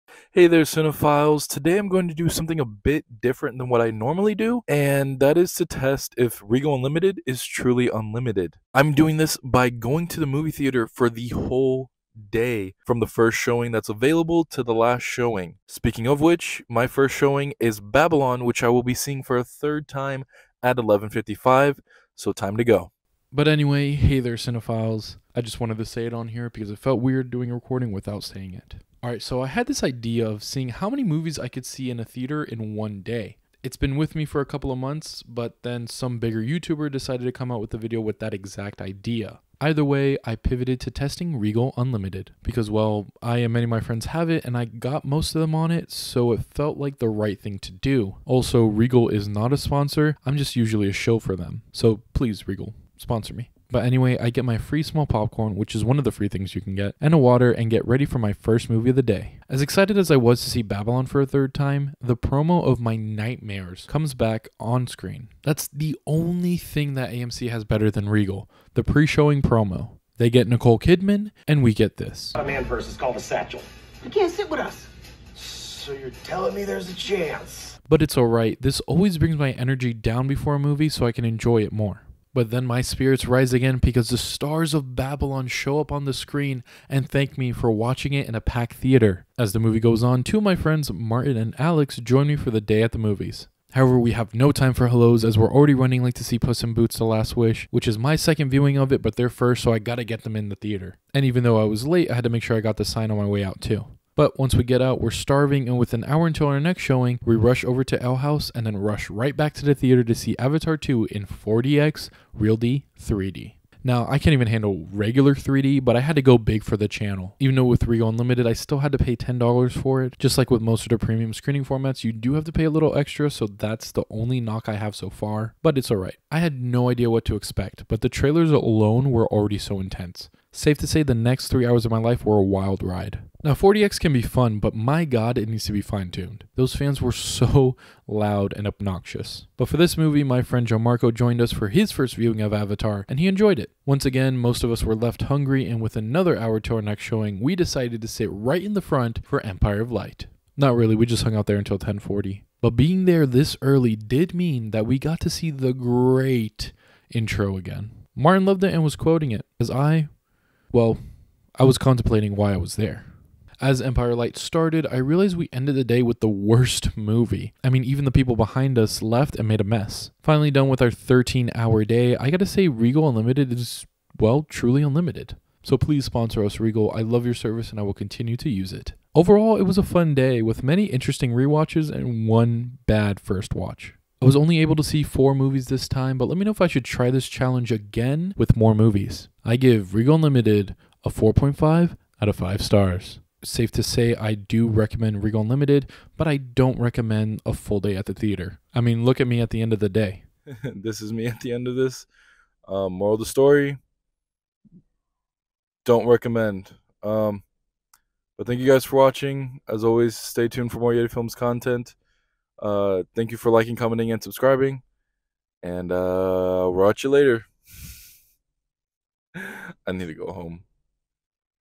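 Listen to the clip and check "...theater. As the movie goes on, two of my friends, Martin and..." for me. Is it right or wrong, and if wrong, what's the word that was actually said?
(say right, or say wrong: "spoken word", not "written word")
right.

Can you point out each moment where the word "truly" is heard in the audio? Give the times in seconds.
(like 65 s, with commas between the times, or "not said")
7 s, 174 s.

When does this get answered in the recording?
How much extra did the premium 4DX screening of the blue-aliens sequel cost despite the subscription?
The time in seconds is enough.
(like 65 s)
119 s.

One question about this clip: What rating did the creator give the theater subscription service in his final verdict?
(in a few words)
4.5 out of 5 stars.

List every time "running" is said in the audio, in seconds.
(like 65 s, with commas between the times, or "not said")
95 s.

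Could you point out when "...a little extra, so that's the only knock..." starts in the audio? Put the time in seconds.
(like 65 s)
122 s.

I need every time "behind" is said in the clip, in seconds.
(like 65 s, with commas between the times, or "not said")
168 s.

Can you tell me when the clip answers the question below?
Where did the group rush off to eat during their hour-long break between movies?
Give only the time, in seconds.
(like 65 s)
108 s.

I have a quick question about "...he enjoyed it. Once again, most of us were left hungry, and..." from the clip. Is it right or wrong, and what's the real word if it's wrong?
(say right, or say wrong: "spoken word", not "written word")
right.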